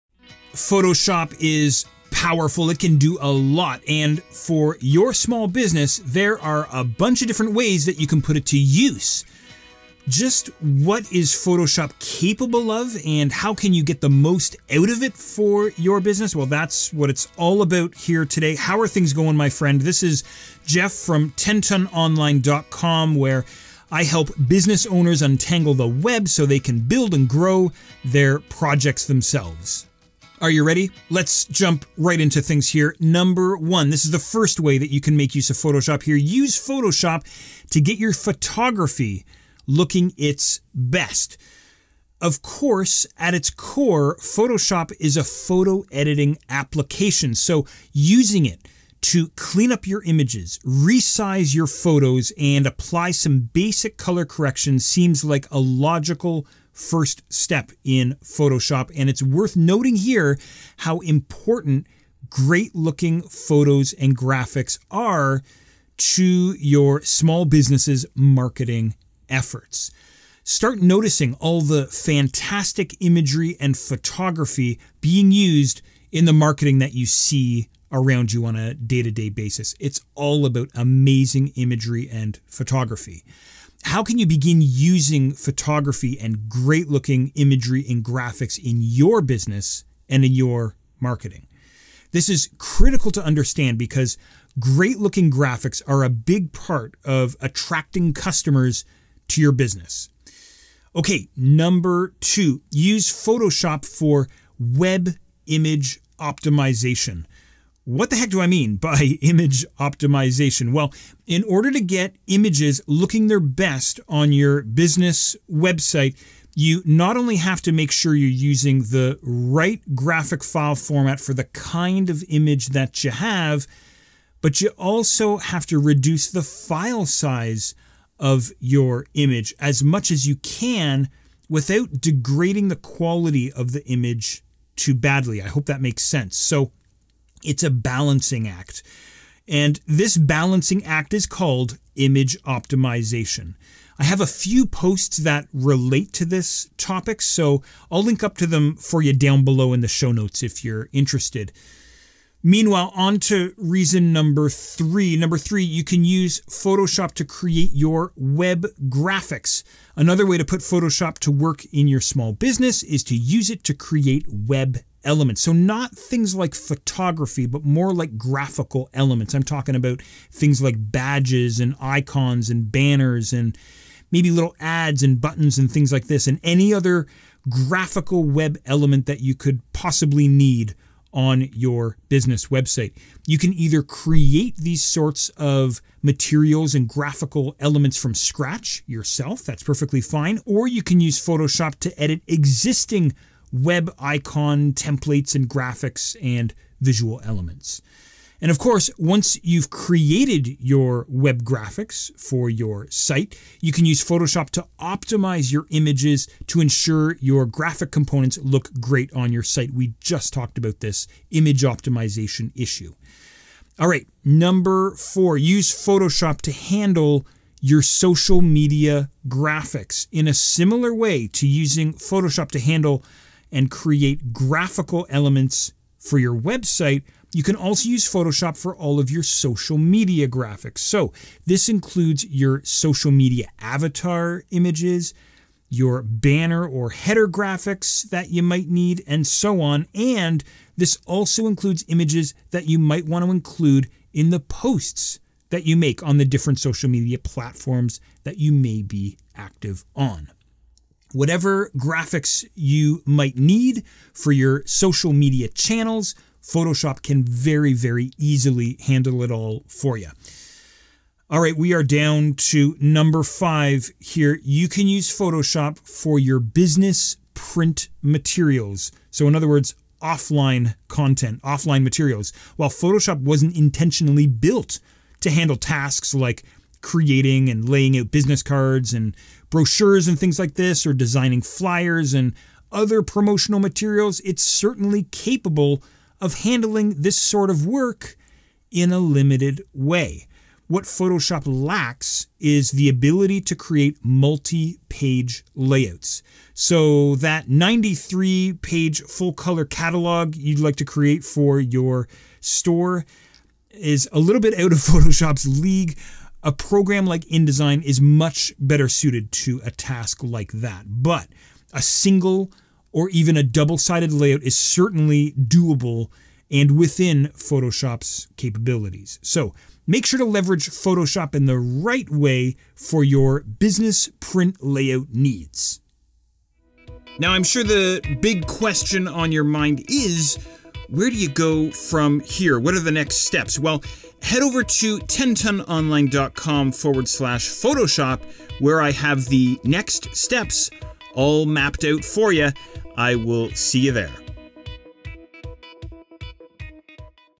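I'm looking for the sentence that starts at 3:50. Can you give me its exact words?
So this includes your social media avatar images, your banner or header graphics that you might need, and so on.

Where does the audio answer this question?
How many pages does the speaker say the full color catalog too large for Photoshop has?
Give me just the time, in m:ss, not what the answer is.
4:57.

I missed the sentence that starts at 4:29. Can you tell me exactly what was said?
So, in other words, offline content, offline materials.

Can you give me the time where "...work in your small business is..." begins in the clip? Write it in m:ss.
2:41.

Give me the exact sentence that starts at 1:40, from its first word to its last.
Okay, number two, use Photoshop for web image optimization.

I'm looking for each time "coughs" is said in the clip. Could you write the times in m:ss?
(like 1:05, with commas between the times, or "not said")
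not said.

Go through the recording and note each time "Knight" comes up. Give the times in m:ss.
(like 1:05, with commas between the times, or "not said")
not said.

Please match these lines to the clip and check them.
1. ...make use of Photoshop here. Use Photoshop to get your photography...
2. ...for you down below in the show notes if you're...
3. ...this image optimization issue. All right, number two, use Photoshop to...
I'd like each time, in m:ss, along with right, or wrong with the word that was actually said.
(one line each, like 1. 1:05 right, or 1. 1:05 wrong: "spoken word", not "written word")
1. 0:35 right
2. 2:28 right
3. 3:30 wrong: "four", not "two".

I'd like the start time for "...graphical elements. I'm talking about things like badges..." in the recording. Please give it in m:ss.
2:48.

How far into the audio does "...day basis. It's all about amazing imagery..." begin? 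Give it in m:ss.
1:19.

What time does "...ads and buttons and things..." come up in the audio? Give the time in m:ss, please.
2:54.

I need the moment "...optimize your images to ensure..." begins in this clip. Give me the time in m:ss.
3:24.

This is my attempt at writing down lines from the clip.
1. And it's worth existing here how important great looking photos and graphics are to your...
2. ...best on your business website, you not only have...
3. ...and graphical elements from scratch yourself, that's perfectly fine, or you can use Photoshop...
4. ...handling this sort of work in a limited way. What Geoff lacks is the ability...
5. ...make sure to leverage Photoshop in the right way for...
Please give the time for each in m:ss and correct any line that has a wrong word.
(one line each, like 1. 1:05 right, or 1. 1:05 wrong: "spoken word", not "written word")
1. 0:58 wrong: "noting", not "existing"
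2. 1:53 right
3. 3:06 right
4. 4:46 wrong: "Photoshop", not "Geoff"
5. 5:19 right.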